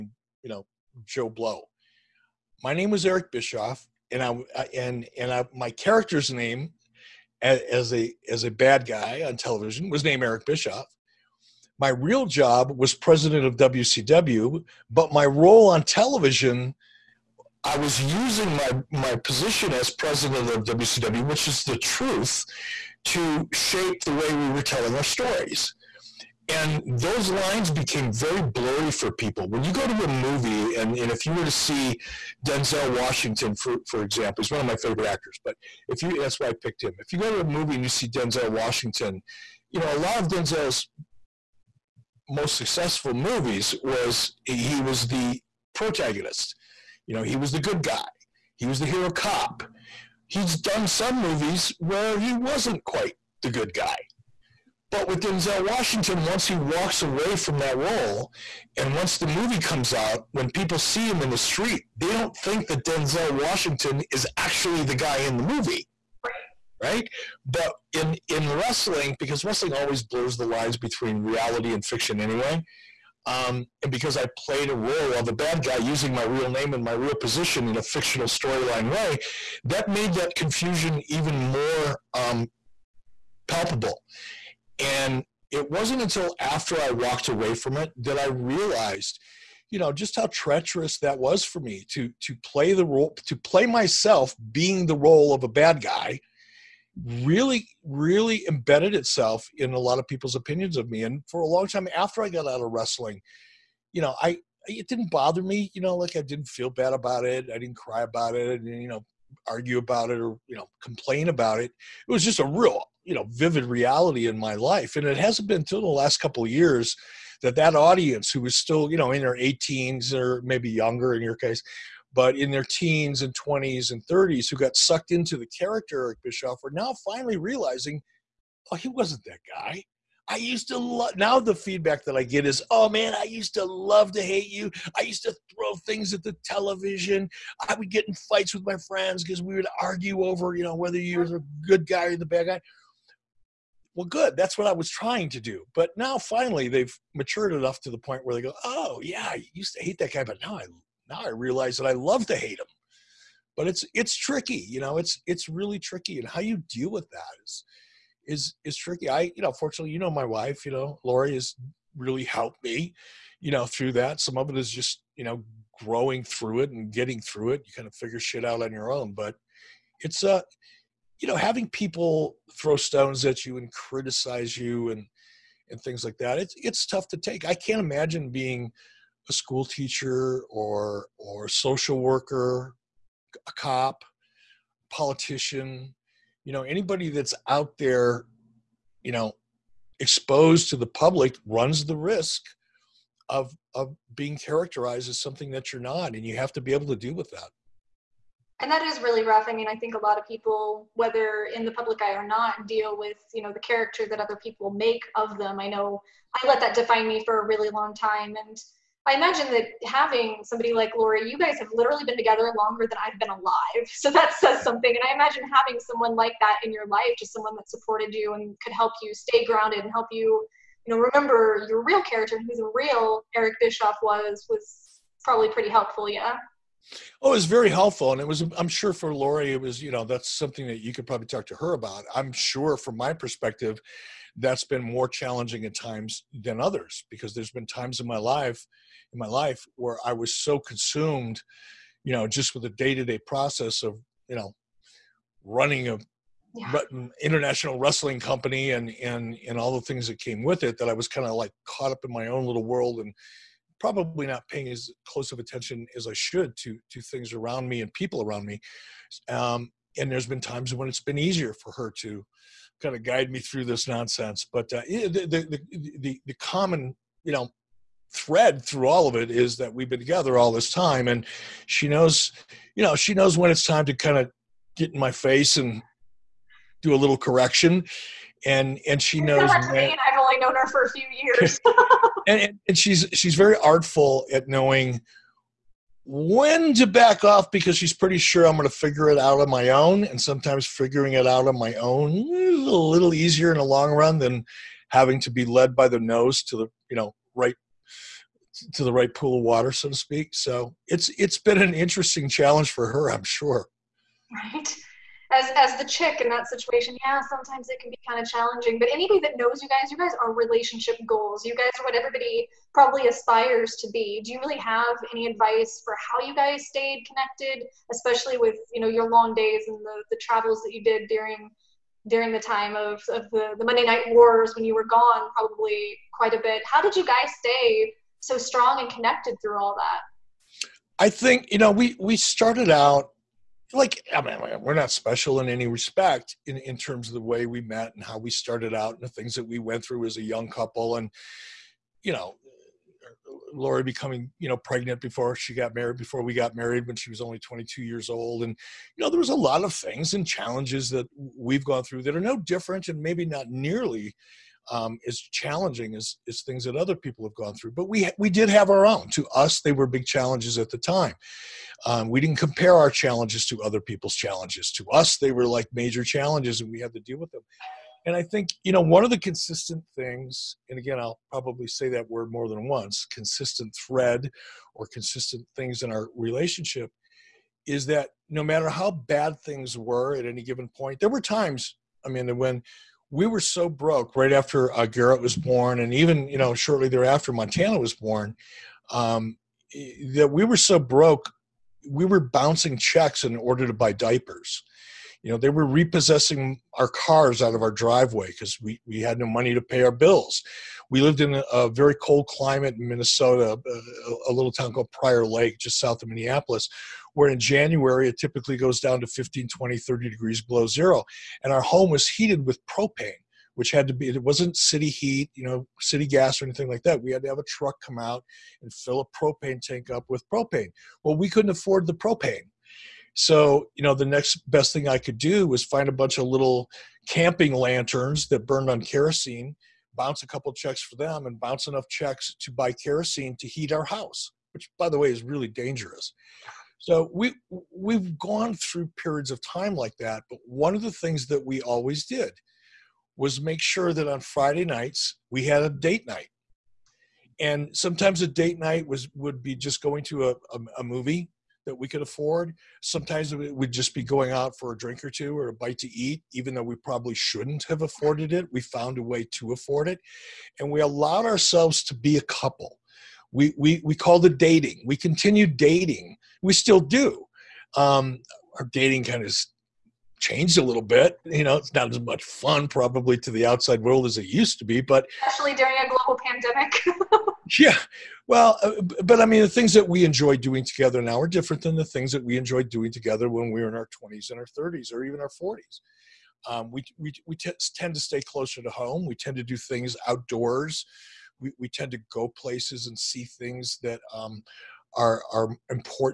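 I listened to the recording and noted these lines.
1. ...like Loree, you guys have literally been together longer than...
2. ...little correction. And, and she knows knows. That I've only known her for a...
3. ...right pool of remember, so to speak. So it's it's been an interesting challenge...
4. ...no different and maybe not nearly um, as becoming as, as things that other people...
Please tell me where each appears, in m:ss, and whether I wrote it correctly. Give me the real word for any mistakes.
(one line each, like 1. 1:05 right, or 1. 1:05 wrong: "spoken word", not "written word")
1. 3:30 right
2. 4:36 right
3. 4:58 wrong: "water", not "remember"
4. 5:52 wrong: "challenging", not "becoming".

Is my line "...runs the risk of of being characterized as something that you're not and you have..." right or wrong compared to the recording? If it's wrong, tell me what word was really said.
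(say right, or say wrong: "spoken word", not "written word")
right.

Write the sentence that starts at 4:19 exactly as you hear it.
Um, and there's been times when it's been easier for her to kind of guide me through this nonsense.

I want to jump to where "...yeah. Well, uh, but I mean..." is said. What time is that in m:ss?
7:57.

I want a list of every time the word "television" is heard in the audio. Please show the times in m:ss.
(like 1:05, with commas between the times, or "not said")
0:09, 0:15, 2:16.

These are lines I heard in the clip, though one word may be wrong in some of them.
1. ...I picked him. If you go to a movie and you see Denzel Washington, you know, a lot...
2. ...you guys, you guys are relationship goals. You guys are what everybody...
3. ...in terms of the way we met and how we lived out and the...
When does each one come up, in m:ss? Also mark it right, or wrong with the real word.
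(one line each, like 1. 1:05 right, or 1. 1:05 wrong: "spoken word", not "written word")
1. 0:36 right
2. 5:09 right
3. 5:36 wrong: "started", not "lived".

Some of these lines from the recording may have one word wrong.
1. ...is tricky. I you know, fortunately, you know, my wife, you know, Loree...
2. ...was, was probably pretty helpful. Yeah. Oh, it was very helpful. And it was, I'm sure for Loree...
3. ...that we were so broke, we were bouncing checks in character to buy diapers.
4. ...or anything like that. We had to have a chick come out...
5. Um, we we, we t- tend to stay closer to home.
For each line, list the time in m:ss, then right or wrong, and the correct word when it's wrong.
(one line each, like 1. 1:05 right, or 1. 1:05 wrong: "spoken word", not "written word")
1. 2:38 right
2. 3:44 right
3. 6:30 wrong: "order", not "character"
4. 6:56 wrong: "truck", not "chick"
5. 8:06 right.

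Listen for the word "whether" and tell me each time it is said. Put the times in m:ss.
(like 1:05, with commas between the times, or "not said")
2:20, 3:20.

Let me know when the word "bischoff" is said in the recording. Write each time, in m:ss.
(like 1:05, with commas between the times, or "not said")
0:03, 0:10, 2:06, 3:43.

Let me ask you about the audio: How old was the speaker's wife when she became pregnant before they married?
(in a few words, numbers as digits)
22.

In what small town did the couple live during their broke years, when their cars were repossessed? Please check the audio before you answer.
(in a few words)
Prior Lake.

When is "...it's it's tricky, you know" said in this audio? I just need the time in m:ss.
2:33.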